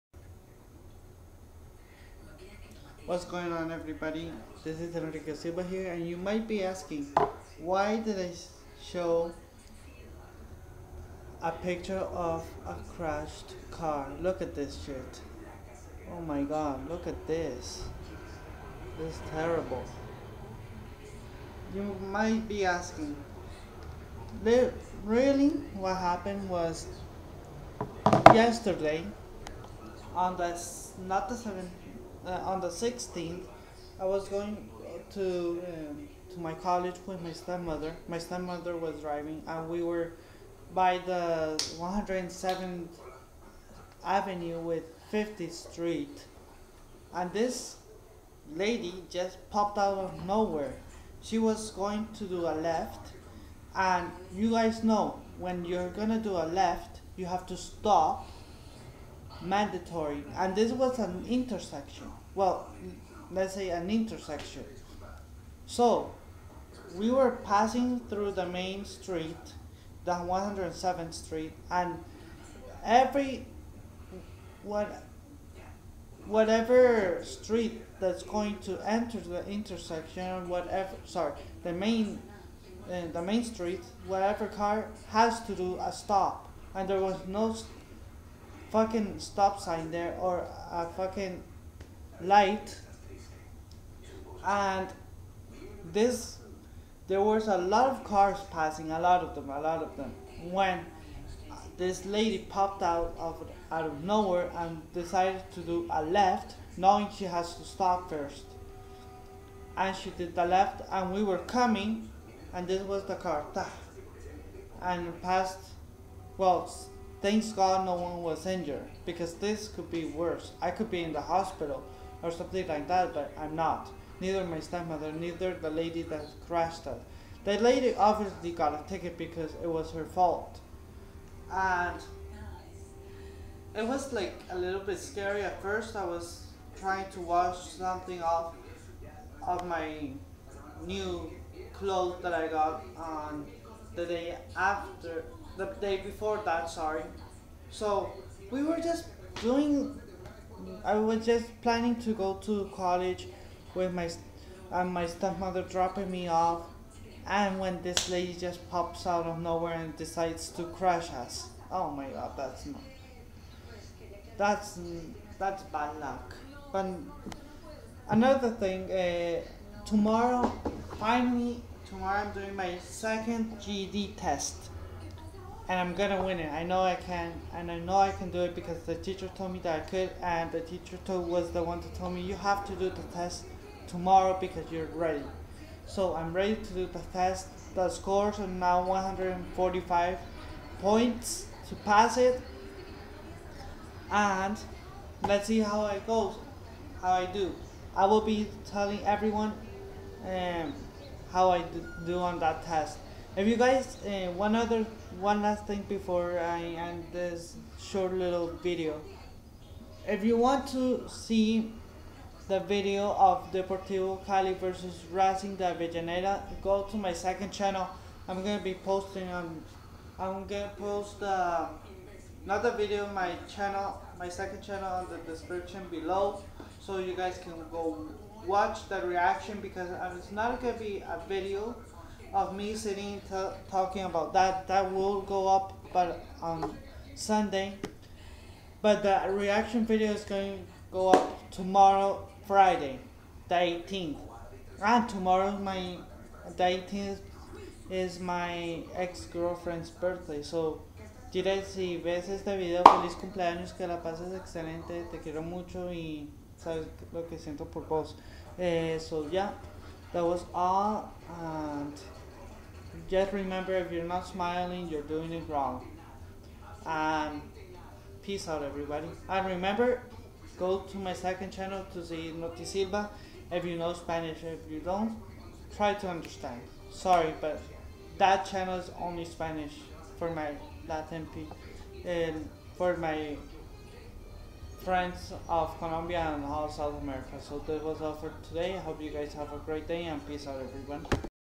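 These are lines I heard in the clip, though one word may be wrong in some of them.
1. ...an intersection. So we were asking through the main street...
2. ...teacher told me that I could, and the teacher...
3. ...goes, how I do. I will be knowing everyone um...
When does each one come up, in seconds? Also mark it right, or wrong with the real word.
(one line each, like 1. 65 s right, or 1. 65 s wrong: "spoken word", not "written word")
1. 63 s wrong: "passing", not "asking"
2. 178 s right
3. 196 s wrong: "telling", not "knowing".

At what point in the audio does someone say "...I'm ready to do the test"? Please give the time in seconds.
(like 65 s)
186 s.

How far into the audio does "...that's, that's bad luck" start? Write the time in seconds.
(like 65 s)
164 s.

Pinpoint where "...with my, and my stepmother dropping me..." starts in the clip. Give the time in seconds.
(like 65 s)
153 s.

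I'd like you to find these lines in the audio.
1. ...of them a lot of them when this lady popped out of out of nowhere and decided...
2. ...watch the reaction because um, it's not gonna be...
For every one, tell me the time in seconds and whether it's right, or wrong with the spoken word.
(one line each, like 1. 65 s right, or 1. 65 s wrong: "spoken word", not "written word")
1. 99 s right
2. 228 s right.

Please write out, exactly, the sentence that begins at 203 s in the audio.
If you guys, uh, one other, one last thing before I end this short little video.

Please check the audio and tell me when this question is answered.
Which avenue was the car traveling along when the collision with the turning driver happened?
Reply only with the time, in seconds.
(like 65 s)
41 s.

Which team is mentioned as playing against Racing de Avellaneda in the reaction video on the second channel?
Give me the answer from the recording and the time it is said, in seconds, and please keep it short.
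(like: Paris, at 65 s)
Deportivo Cali, at 213 s.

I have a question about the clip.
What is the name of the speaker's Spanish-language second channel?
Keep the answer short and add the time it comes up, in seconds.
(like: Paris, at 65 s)
Notisilva, at 272 s.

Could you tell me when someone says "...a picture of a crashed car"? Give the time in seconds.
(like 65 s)
11 s.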